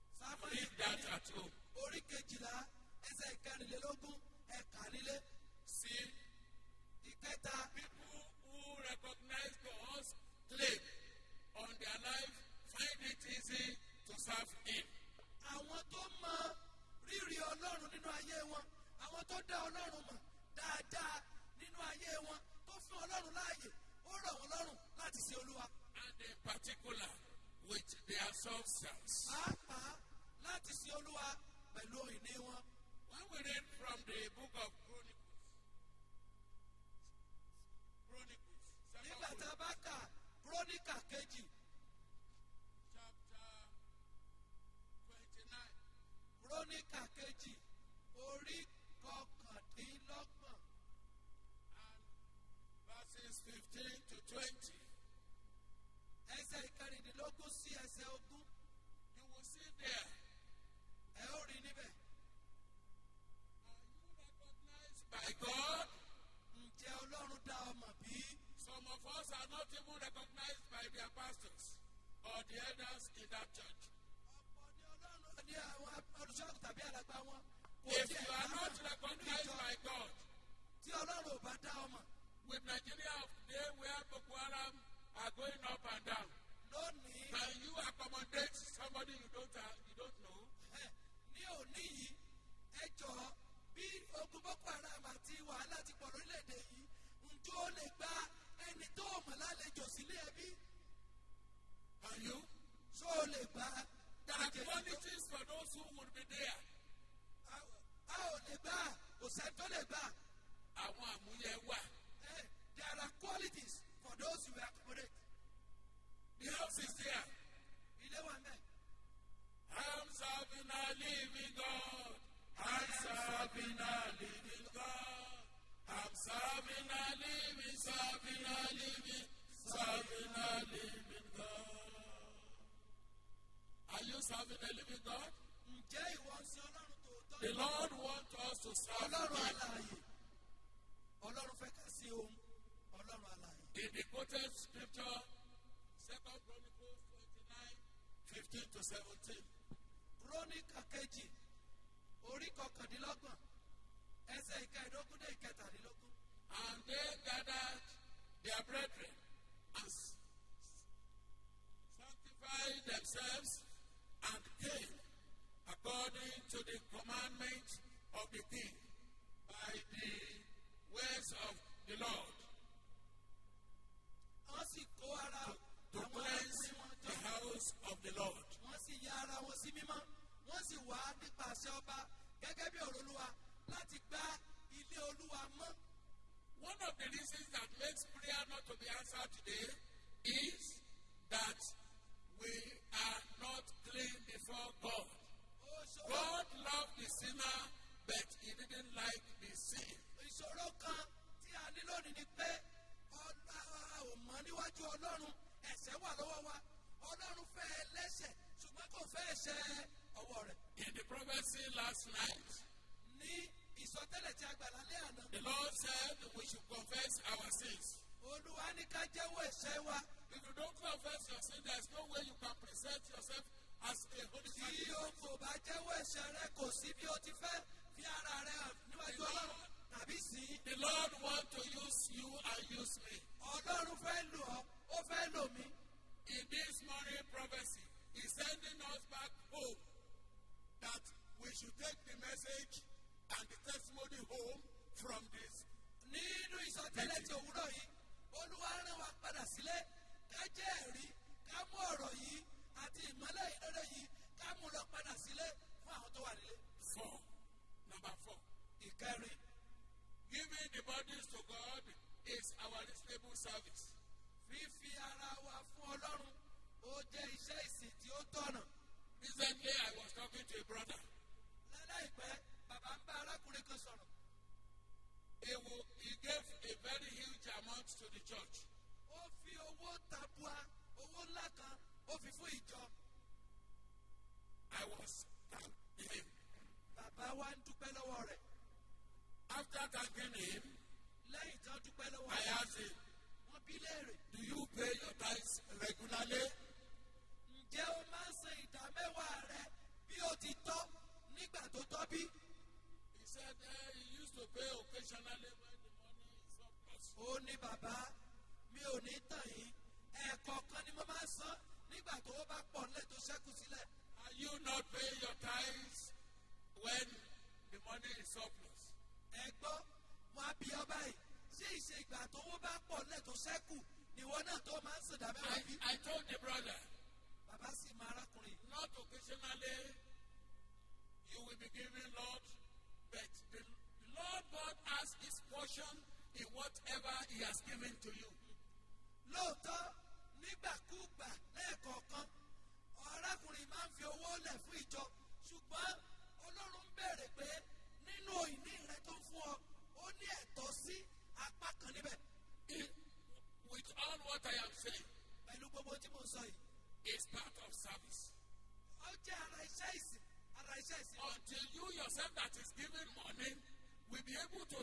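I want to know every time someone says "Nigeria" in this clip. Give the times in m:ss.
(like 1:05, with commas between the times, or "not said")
1:22.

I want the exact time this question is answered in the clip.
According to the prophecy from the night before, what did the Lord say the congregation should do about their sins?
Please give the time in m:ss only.
3:36.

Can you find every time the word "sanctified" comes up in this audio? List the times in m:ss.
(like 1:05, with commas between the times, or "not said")
2:41.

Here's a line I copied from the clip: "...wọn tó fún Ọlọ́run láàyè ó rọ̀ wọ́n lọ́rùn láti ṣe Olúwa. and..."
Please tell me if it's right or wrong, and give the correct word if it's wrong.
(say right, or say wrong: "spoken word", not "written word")
right.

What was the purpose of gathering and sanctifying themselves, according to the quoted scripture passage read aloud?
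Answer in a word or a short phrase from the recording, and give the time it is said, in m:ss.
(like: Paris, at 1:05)
To cleanse the house of the Lord, at 2:55.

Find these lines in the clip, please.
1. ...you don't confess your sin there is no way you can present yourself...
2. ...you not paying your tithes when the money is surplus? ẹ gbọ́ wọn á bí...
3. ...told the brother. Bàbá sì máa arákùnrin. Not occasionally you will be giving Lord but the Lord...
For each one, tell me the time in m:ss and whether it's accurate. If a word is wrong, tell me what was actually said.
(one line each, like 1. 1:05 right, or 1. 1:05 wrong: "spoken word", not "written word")
1. 3:40 right
2. 5:14 right
3. 5:26 right.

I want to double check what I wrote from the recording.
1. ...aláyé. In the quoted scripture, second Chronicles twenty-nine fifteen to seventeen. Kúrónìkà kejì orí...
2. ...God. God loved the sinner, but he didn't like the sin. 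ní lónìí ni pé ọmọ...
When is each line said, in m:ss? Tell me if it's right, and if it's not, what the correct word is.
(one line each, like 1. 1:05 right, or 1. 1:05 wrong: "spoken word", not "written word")
1. 2:23 right
2. 3:14 right.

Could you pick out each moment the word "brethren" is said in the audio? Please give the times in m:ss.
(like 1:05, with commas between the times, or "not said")
2:38.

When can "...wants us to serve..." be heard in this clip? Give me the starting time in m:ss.
2:18.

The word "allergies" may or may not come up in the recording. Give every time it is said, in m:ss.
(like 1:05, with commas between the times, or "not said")
not said.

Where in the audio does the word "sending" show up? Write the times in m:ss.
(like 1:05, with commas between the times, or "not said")
3:58.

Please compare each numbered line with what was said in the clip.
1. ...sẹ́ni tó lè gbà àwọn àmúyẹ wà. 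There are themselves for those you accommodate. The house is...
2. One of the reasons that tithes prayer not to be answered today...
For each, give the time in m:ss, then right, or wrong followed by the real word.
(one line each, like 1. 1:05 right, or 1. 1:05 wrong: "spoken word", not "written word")
1. 1:49 wrong: "qualities", not "themselves"
2. 3:06 wrong: "makes", not "tithes".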